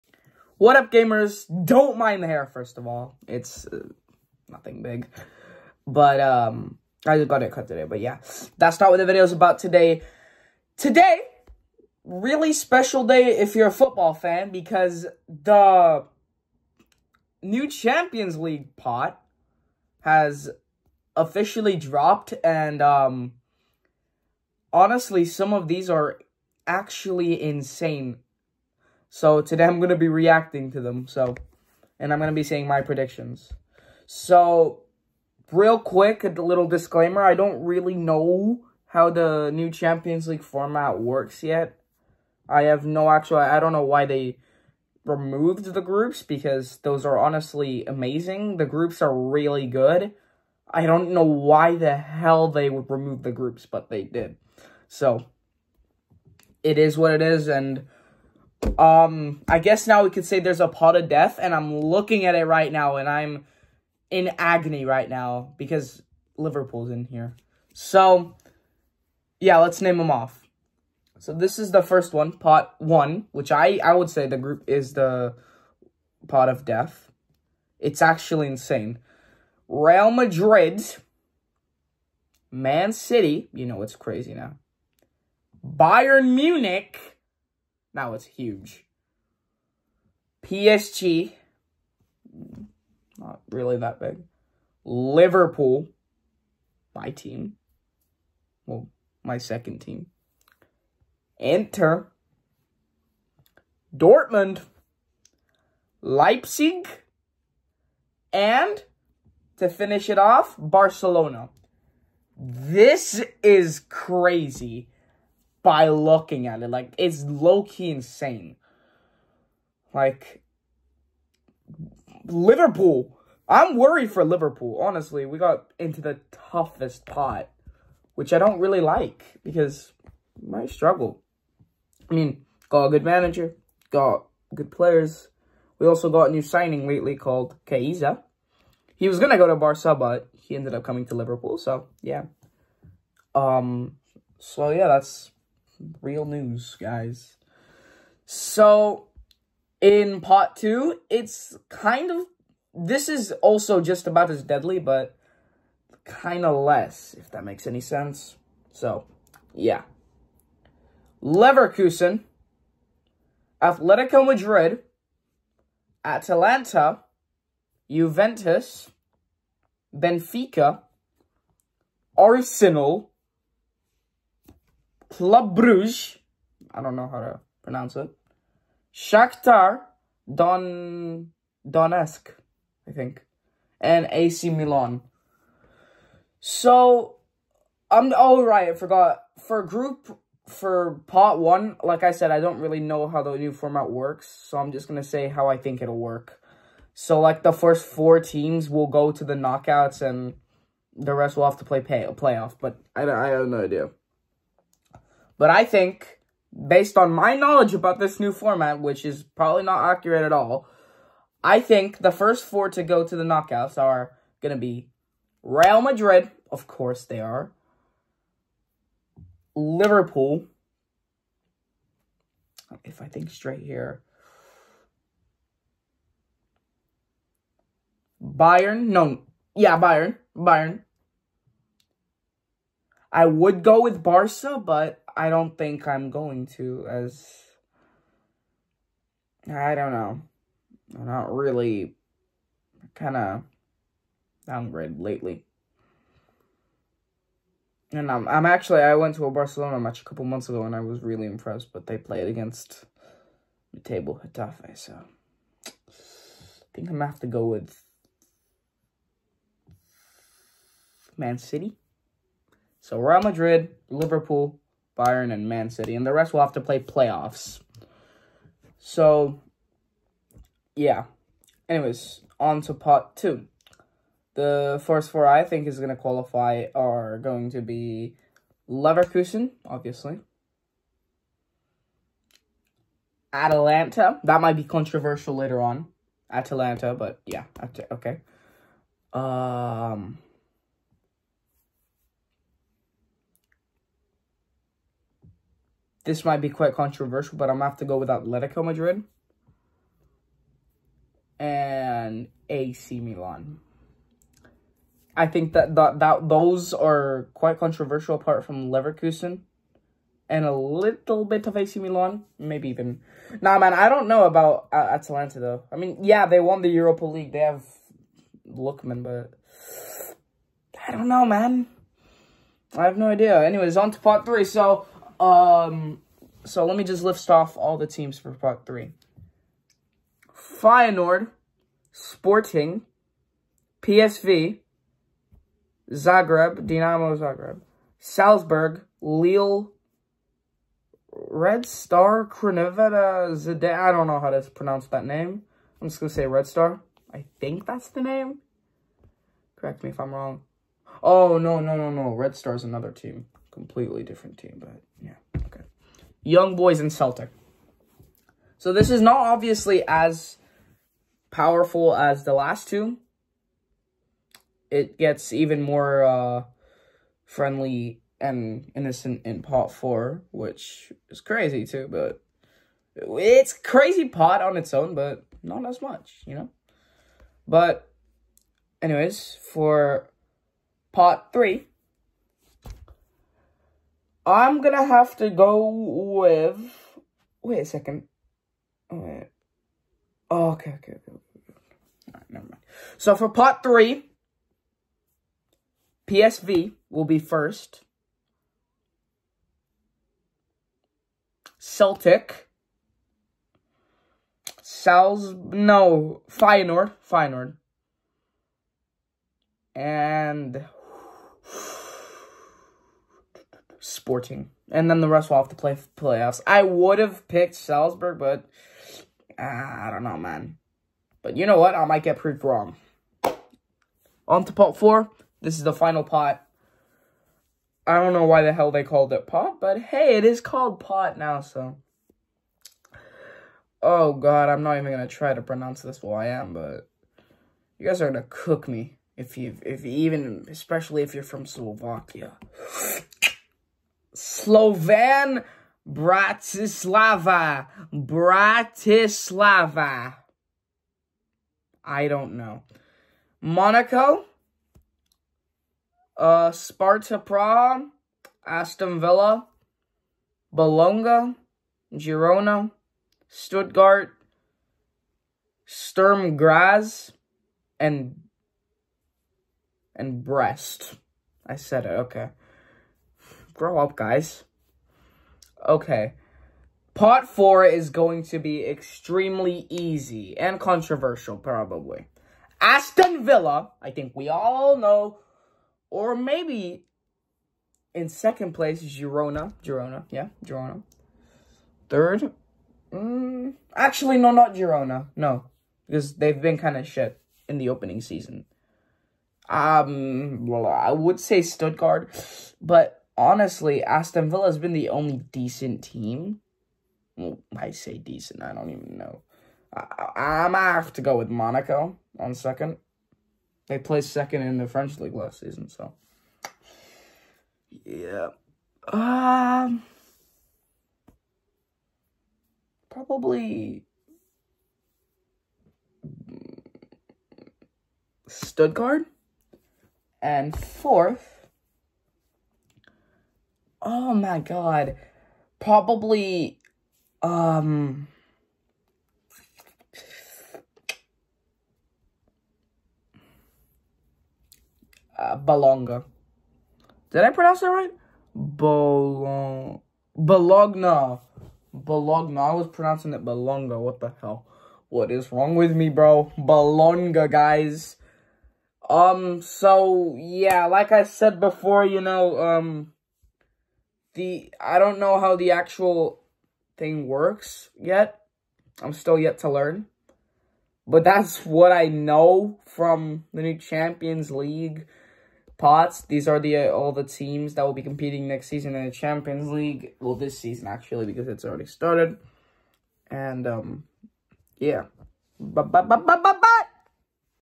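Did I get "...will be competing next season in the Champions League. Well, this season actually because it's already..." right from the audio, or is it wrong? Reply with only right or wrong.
right.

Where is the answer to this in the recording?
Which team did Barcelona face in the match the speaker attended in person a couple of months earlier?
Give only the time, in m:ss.
4:14.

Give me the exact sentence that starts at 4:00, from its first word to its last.
I'm not really kind of downgrade lately.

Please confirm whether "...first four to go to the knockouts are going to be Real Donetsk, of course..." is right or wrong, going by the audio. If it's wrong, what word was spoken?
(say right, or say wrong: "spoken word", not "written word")
wrong: "Madrid", not "Donetsk".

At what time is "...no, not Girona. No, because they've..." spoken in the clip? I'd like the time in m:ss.
8:14.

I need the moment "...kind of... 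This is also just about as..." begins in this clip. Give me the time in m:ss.
2:31.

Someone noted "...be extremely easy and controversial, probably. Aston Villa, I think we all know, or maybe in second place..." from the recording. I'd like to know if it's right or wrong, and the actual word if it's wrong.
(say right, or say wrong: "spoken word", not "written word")
right.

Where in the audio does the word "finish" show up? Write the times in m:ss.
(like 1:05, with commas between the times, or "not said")
1:49.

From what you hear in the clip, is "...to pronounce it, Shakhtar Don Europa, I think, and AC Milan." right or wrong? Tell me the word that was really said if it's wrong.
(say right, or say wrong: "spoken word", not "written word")
wrong: "Donetsk", not "Europa".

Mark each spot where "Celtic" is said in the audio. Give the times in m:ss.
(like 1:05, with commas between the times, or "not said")
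5:56, 6:41.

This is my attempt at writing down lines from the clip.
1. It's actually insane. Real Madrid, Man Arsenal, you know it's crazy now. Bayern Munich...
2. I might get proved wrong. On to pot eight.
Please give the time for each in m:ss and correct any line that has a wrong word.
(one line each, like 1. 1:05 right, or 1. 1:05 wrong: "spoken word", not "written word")
1. 1:17 wrong: "City", not "Arsenal"
2. 7:01 wrong: "four", not "eight".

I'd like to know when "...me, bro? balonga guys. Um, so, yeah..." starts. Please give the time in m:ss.
9:15.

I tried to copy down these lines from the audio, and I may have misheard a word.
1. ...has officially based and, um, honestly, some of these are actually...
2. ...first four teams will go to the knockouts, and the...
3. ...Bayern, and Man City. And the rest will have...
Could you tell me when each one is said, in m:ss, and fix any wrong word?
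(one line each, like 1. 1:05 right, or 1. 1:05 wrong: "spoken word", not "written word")
1. 0:20 wrong: "dropped", not "based"
2. 3:17 right
3. 4:24 right.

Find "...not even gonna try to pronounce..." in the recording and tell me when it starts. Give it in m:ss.
7:14.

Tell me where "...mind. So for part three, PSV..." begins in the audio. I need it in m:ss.
6:32.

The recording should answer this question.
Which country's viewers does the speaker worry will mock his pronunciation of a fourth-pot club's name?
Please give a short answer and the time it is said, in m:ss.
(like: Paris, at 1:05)
Slovakia, at 7:21.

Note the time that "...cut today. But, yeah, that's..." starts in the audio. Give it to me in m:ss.
0:07.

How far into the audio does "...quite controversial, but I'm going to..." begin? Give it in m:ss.
4:56.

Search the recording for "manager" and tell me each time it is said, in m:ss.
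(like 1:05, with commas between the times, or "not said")
2:13.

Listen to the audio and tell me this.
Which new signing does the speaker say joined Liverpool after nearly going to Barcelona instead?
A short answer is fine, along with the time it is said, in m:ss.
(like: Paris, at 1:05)
Chiesa, at 2:17.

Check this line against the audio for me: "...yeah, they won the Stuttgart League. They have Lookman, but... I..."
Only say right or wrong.
wrong.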